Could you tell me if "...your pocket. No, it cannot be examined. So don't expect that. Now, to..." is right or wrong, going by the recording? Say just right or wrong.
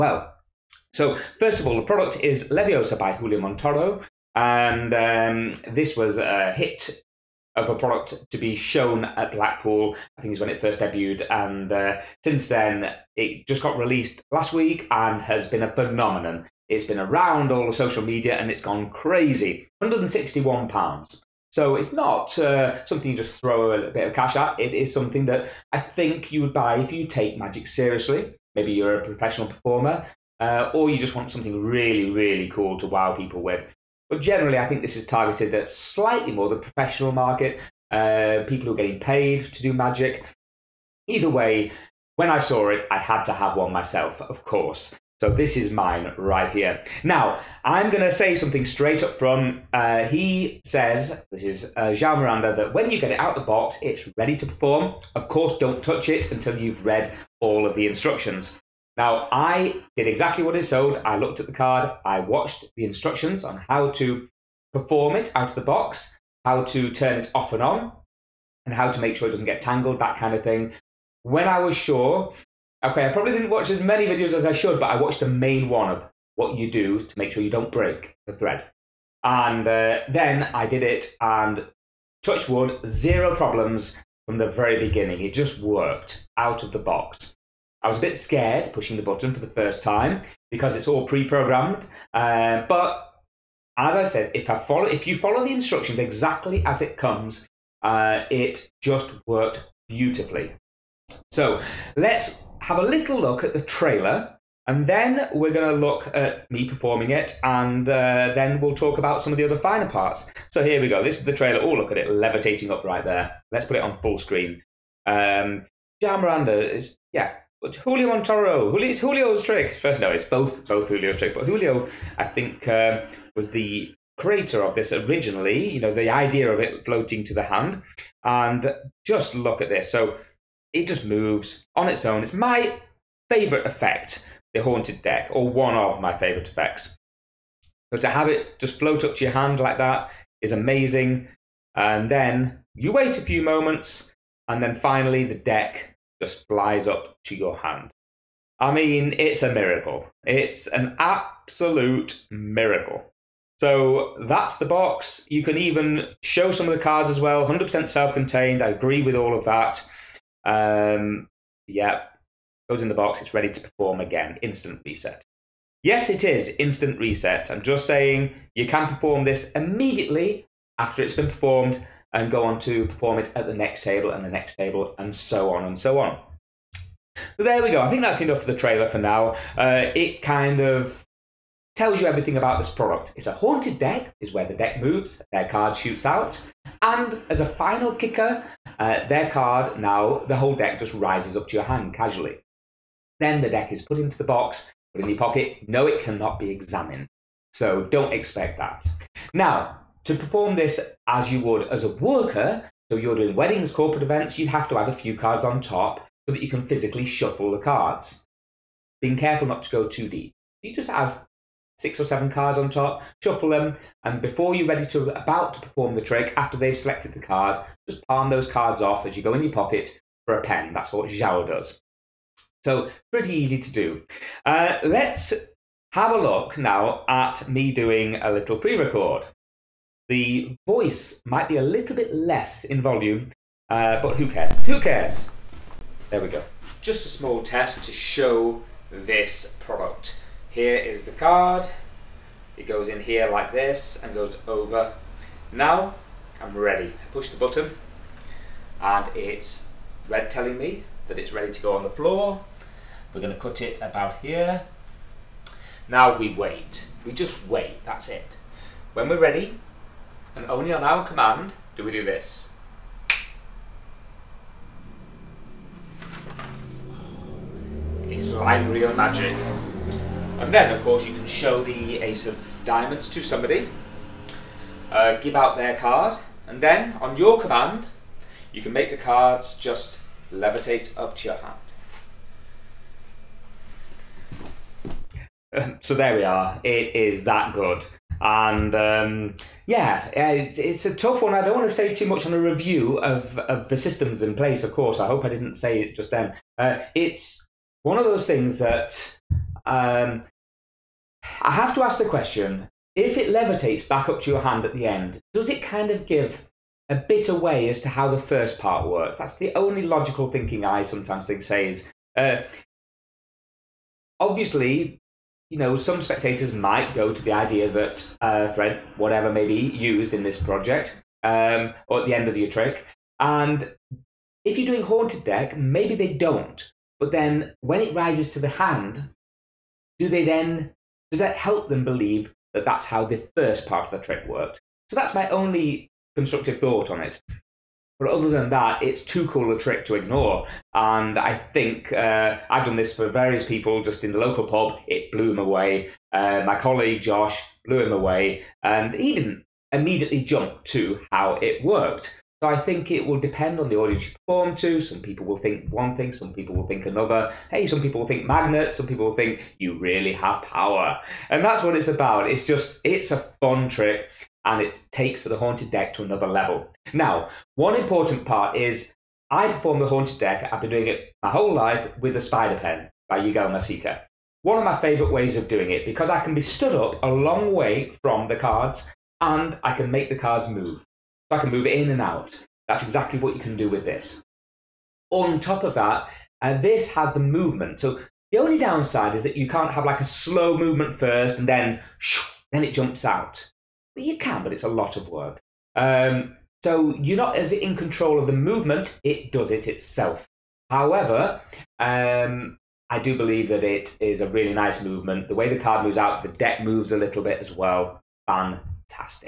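right.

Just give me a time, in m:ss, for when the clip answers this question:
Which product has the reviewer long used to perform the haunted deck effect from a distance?
6:12.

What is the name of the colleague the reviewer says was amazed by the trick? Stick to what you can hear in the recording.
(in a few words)
Josh.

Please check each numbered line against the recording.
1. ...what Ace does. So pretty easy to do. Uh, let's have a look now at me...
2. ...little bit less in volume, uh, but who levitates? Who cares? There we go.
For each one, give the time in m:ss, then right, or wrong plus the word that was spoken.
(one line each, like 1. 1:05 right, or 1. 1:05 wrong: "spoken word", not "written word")
1. 3:40 wrong: "Joao", not "Ace"
2. 3:51 wrong: "cares", not "levitates".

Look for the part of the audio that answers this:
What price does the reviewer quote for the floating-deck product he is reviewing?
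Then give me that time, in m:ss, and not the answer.
0:19.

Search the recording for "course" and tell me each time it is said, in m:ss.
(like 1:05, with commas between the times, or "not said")
0:44, 0:55, 4:30, 4:54.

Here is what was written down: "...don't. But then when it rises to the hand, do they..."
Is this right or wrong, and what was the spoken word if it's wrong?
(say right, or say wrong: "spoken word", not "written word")
right.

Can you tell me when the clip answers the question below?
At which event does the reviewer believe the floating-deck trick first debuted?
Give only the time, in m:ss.
0:09.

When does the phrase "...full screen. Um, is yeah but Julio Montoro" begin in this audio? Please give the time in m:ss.
1:54.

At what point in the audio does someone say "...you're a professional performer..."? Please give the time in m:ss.
0:28.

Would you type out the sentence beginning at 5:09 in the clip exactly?
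That's the only logical thinking I sometimes think says.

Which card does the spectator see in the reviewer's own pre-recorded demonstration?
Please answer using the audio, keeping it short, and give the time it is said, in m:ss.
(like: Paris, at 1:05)
Ace of Diamonds, at 4:31.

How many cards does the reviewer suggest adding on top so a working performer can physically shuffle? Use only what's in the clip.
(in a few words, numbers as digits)
six or seven.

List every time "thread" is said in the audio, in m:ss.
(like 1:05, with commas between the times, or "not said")
1:18, 5:18.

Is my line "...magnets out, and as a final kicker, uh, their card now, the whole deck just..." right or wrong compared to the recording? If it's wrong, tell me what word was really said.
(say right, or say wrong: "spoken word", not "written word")
wrong: "shoots", not "magnets".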